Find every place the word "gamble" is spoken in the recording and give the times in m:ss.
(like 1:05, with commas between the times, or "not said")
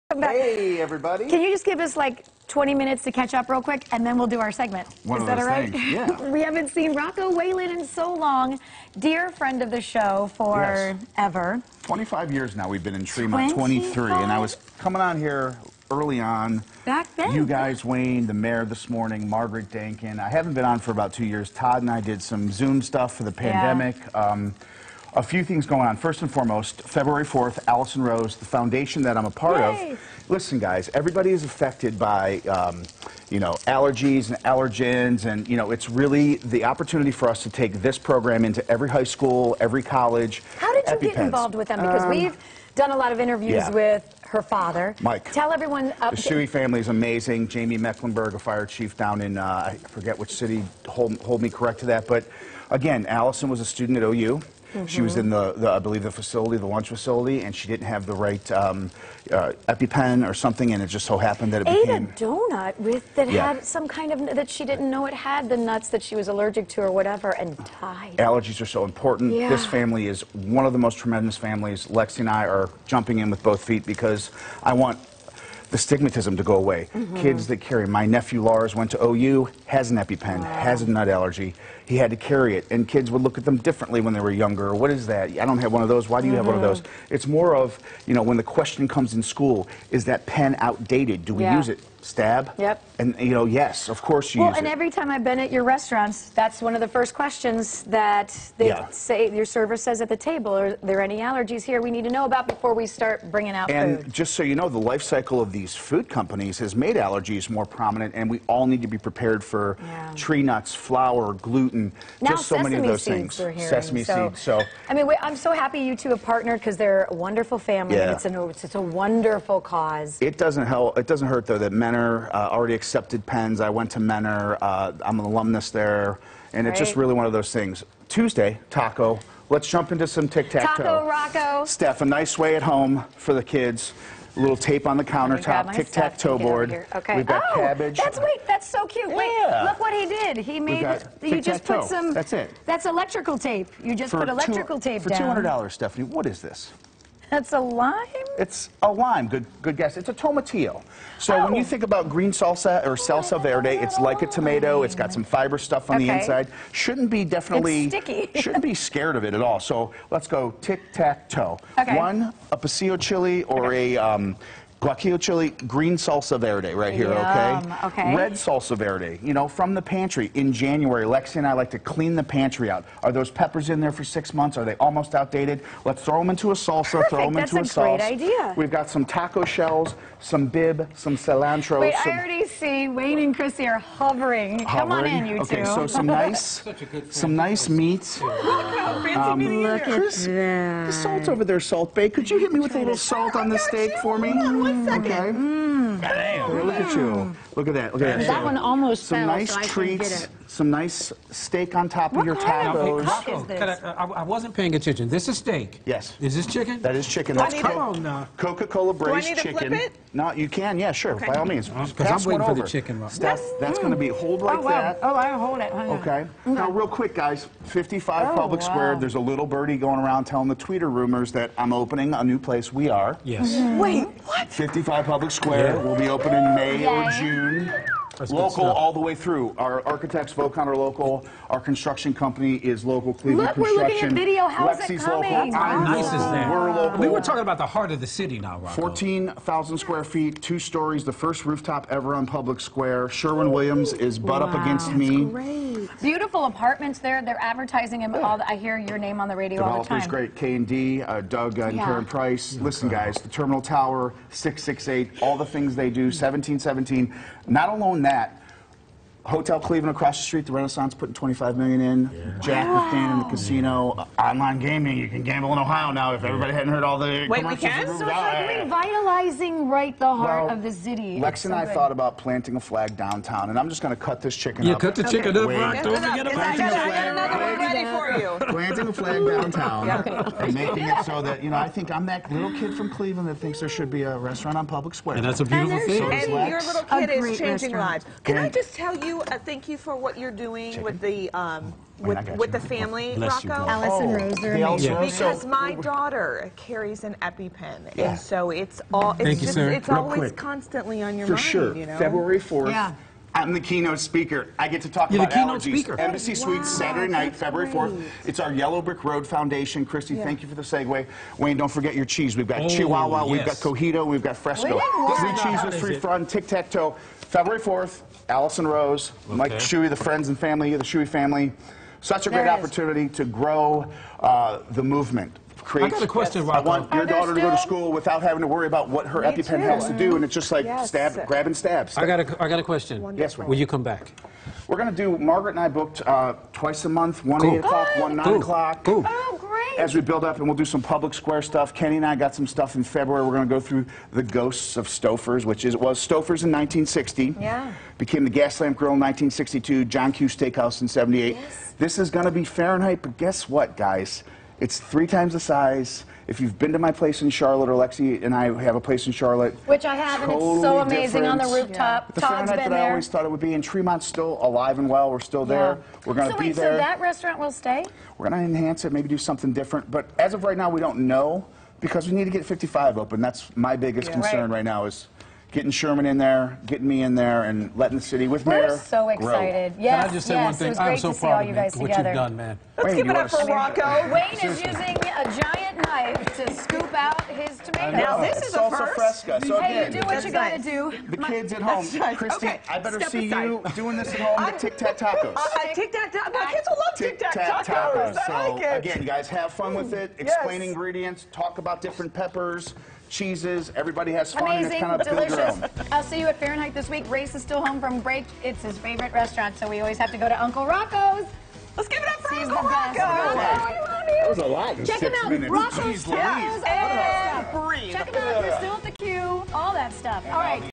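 4:25.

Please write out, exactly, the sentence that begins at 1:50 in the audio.
tree nuts, flour, gluten, now, just so many of those things.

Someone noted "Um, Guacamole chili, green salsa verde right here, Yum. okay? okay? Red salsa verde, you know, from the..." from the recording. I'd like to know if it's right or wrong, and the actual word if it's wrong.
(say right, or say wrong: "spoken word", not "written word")
right.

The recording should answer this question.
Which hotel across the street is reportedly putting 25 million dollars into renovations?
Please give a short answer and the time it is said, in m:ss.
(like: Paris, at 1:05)
Renaissance, at 4:20.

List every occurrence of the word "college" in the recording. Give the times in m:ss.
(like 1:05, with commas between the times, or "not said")
0:39.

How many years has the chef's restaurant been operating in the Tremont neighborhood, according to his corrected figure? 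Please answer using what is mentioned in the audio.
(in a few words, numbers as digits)
23.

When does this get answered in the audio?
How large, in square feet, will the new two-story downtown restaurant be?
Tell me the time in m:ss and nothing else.
3:58.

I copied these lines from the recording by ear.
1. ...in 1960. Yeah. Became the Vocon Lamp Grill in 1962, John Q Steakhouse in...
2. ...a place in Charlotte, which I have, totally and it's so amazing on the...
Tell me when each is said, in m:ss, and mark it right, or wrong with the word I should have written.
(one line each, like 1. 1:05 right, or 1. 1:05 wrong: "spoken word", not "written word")
1. 5:46 wrong: "Gas", not "Vocon"
2. 5:58 right.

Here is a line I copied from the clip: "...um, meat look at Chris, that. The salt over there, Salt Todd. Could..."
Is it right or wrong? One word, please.
wrong.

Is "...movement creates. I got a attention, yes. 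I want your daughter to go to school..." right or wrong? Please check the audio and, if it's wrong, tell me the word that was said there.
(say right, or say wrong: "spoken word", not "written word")
wrong: "question", not "attention".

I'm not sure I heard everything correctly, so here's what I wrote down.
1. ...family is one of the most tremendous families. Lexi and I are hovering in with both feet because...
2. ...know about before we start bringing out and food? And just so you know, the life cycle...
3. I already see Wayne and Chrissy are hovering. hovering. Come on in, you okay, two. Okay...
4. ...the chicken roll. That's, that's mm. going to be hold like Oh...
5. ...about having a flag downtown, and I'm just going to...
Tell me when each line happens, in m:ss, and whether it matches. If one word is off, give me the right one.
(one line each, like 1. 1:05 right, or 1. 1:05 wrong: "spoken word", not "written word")
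1. 1:09 wrong: "jumping", not "hovering"
2. 1:42 right
3. 3:02 right
4. 3:32 right
5. 4:31 wrong: "planting", not "having".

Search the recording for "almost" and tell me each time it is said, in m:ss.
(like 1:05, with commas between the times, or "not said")
2:54, 3:18.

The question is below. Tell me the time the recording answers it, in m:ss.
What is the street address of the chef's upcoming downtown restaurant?
3:44.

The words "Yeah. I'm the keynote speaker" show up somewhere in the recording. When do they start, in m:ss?
5:02.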